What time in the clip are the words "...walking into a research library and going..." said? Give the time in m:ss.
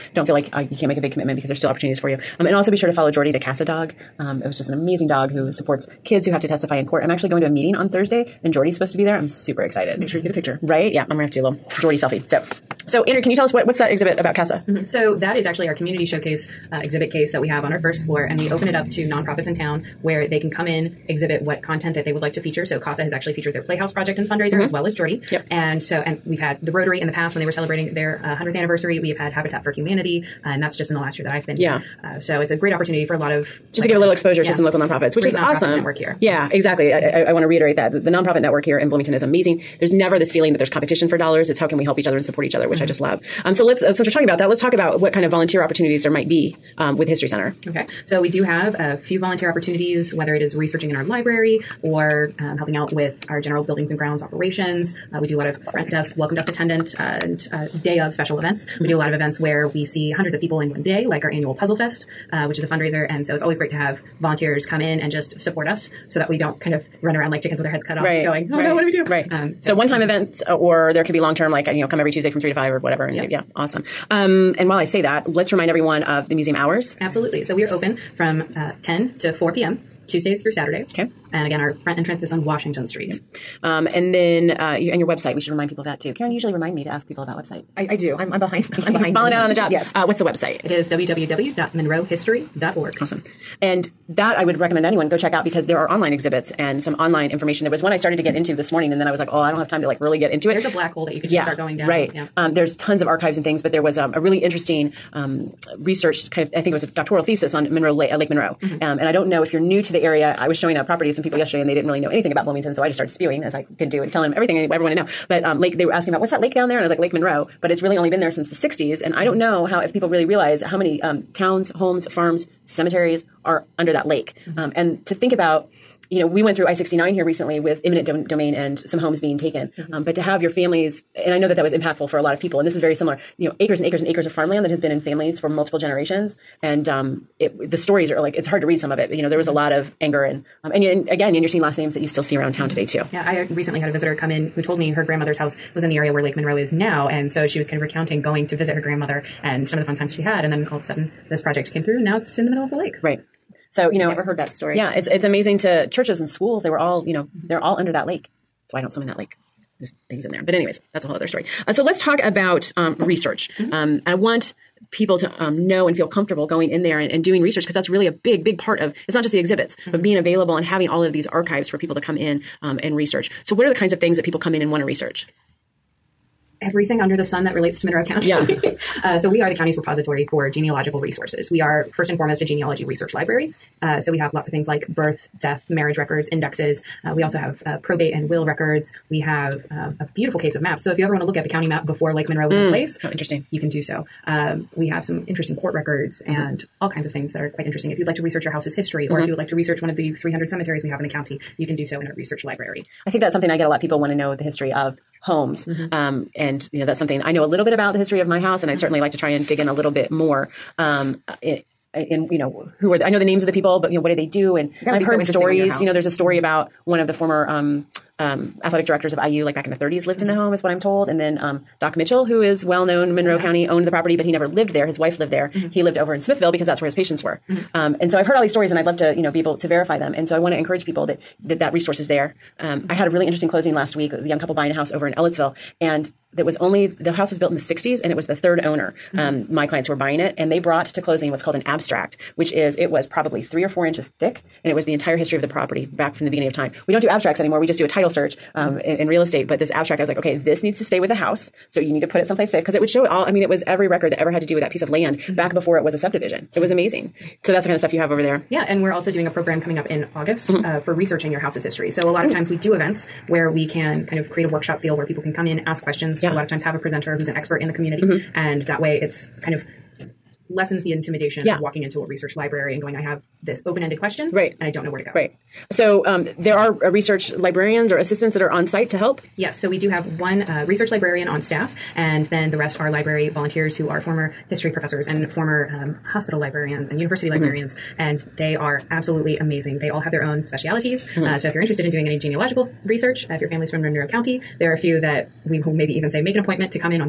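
4:31.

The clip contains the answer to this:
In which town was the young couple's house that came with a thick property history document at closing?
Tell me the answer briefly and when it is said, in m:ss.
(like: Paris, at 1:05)
Ellettsville, at 3:55.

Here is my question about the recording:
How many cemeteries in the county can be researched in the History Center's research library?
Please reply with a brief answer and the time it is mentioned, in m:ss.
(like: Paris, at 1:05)
300, at 3:20.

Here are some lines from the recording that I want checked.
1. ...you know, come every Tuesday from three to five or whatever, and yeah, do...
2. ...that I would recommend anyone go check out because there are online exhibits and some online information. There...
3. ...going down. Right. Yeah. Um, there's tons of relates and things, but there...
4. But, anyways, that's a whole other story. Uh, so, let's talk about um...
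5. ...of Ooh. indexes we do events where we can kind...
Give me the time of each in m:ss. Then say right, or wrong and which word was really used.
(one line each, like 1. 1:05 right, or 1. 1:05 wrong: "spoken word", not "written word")
1. 1:11 right
2. 1:34 right
3. 1:41 wrong: "archives", not "relates"
4. 2:40 right
5. 4:22 wrong: "times", not "indexes".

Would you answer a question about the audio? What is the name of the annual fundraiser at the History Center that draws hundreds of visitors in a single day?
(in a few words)
Puzzle Fest.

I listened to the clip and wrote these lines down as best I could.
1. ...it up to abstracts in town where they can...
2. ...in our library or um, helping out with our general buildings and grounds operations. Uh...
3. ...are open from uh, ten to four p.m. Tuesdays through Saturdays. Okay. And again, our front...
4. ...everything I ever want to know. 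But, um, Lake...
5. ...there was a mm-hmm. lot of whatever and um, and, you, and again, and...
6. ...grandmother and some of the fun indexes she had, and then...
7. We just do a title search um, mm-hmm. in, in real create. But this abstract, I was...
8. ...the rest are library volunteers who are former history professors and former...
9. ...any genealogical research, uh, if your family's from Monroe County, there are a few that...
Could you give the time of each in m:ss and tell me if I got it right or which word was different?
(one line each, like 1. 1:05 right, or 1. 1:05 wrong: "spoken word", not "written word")
1. 0:18 wrong: "nonprofits", not "abstracts"
2. 0:50 right
3. 1:17 right
4. 1:54 right
5. 2:19 wrong: "anger", not "whatever"
6. 2:28 wrong: "times", not "indexes"
7. 4:07 wrong: "estate", not "create"
8. 4:42 right
9. 4:52 right.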